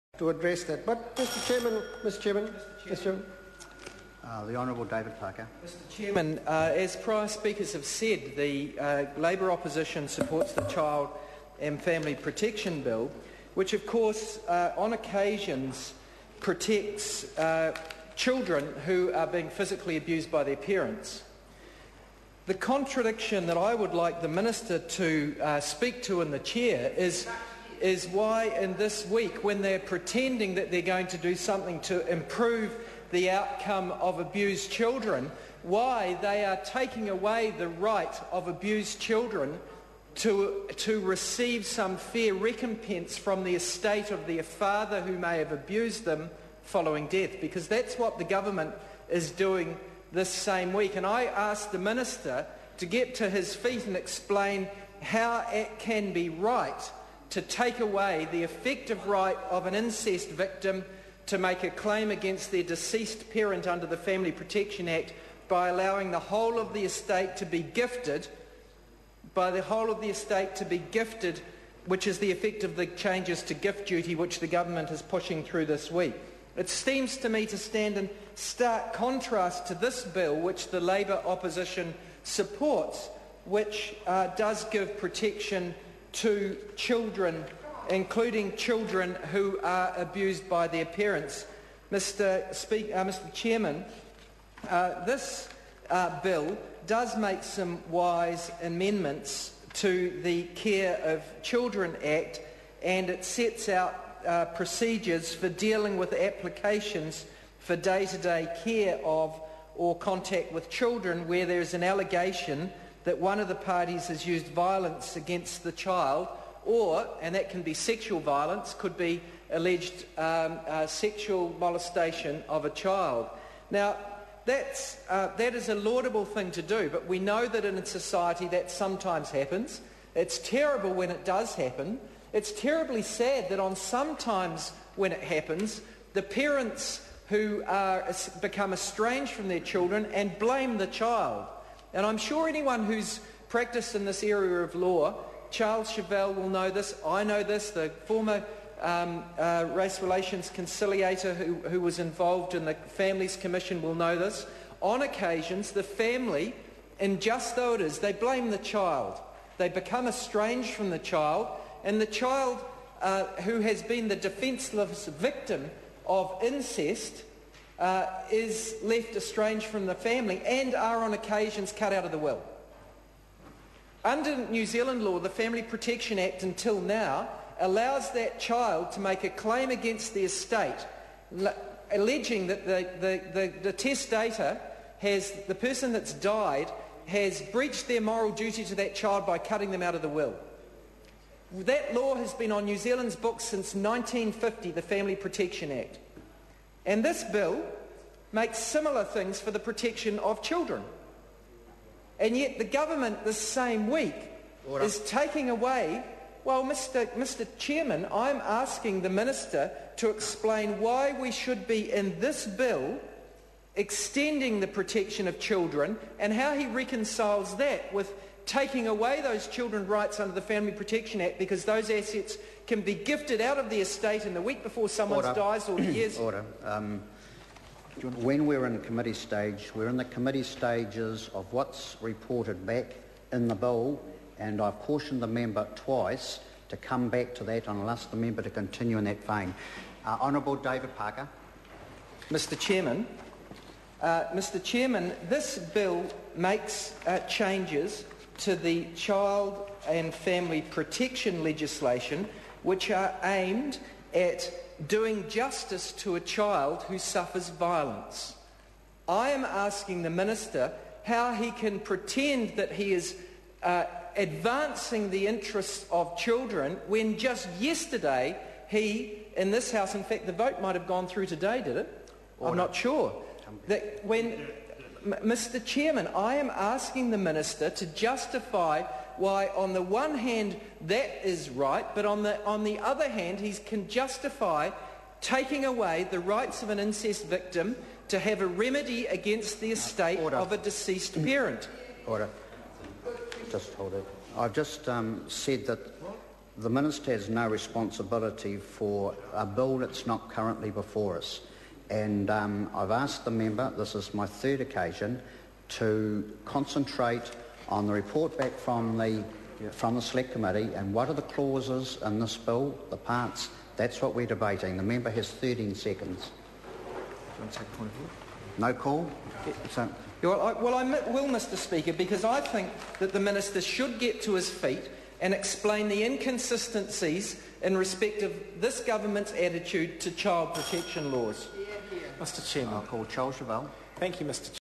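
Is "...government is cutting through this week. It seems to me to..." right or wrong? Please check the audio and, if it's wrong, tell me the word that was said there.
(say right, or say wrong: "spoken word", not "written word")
wrong: "pushing", not "cutting".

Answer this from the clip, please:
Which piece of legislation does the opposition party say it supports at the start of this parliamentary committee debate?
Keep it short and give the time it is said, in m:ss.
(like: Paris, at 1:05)
Child and Family Protection Bill, at 0:10.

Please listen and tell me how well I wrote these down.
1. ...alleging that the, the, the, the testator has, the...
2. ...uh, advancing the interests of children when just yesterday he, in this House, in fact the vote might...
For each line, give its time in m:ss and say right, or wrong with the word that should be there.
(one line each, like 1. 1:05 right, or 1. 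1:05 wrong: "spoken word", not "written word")
1. 3:01 right
2. 4:23 right.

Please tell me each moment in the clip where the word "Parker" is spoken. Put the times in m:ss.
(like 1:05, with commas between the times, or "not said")
0:05, 4:00.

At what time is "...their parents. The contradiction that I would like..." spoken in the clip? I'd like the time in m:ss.
0:20.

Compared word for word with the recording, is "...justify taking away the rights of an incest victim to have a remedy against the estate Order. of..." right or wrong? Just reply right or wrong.
right.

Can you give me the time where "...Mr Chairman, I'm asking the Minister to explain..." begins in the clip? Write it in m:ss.
3:27.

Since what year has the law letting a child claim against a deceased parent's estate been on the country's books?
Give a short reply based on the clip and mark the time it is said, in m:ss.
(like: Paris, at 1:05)
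1950, at 3:13.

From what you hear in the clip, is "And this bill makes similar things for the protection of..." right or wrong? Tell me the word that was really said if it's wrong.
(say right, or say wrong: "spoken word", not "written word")
right.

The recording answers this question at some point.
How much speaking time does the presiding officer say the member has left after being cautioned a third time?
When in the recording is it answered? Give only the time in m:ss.
5:15.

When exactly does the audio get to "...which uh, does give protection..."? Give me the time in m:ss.
1:23.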